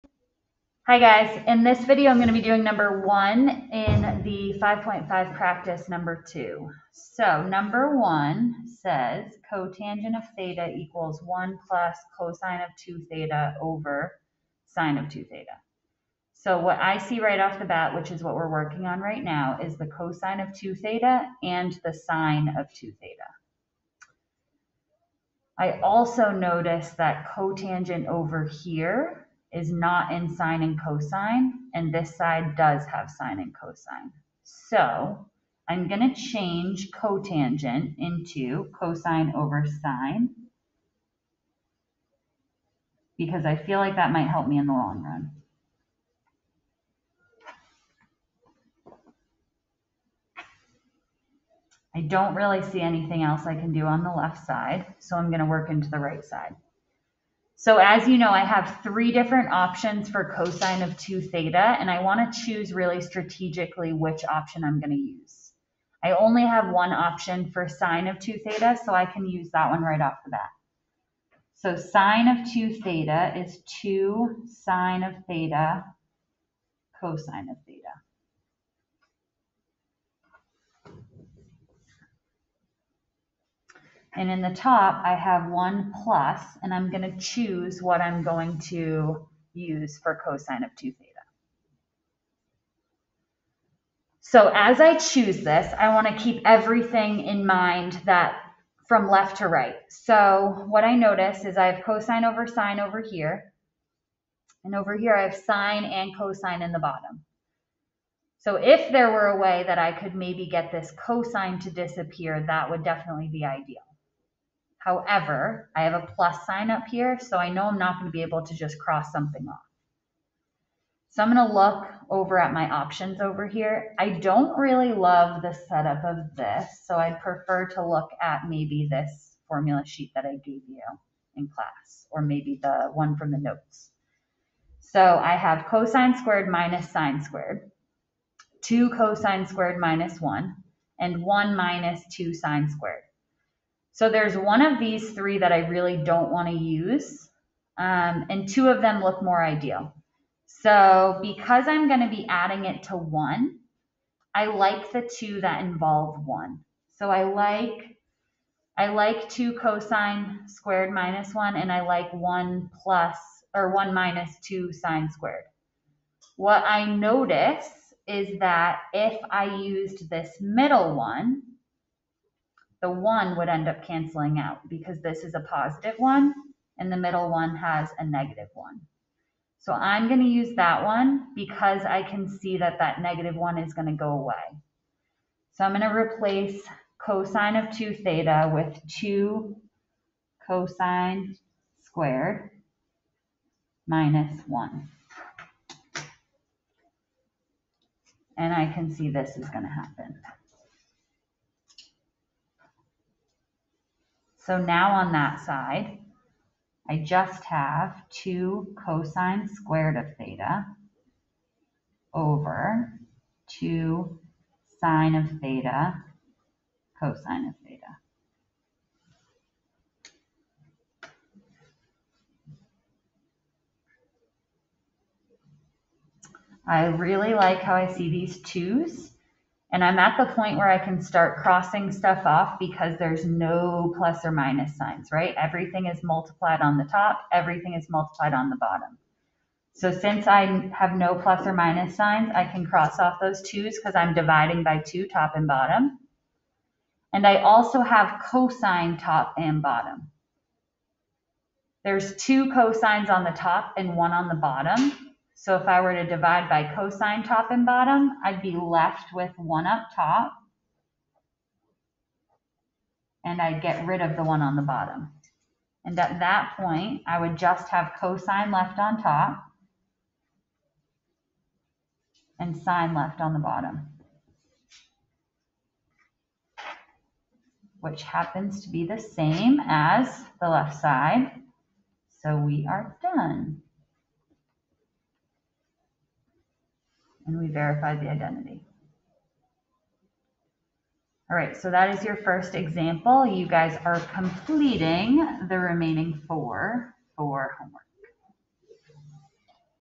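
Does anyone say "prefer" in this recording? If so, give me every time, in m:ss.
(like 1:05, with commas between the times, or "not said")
2:07.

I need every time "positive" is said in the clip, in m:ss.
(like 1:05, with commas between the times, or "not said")
2:55.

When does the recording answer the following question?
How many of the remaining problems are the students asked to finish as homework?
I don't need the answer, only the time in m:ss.
4:56.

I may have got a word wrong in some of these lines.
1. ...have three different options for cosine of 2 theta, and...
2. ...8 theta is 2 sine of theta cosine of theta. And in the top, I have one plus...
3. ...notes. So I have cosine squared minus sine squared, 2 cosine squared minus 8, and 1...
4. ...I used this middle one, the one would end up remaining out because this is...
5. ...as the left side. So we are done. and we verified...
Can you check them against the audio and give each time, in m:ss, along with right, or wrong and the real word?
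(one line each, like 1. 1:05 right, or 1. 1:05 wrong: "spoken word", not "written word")
1. 0:58 right
2. 1:12 wrong: "2", not "8"
3. 2:13 wrong: "1", not "8"
4. 2:49 wrong: "canceling", not "remaining"
5. 4:39 right.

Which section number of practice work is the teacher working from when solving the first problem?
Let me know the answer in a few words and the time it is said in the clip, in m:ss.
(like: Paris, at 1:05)
5.5, at 0:04.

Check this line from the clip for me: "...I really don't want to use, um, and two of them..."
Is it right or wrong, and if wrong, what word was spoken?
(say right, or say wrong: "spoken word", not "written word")
right.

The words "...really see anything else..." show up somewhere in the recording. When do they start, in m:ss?
0:52.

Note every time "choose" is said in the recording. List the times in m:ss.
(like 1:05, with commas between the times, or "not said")
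1:02, 1:27, 1:34.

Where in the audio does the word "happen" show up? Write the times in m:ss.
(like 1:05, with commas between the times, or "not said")
3:19, 4:38.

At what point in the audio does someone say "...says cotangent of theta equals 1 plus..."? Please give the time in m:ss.
0:08.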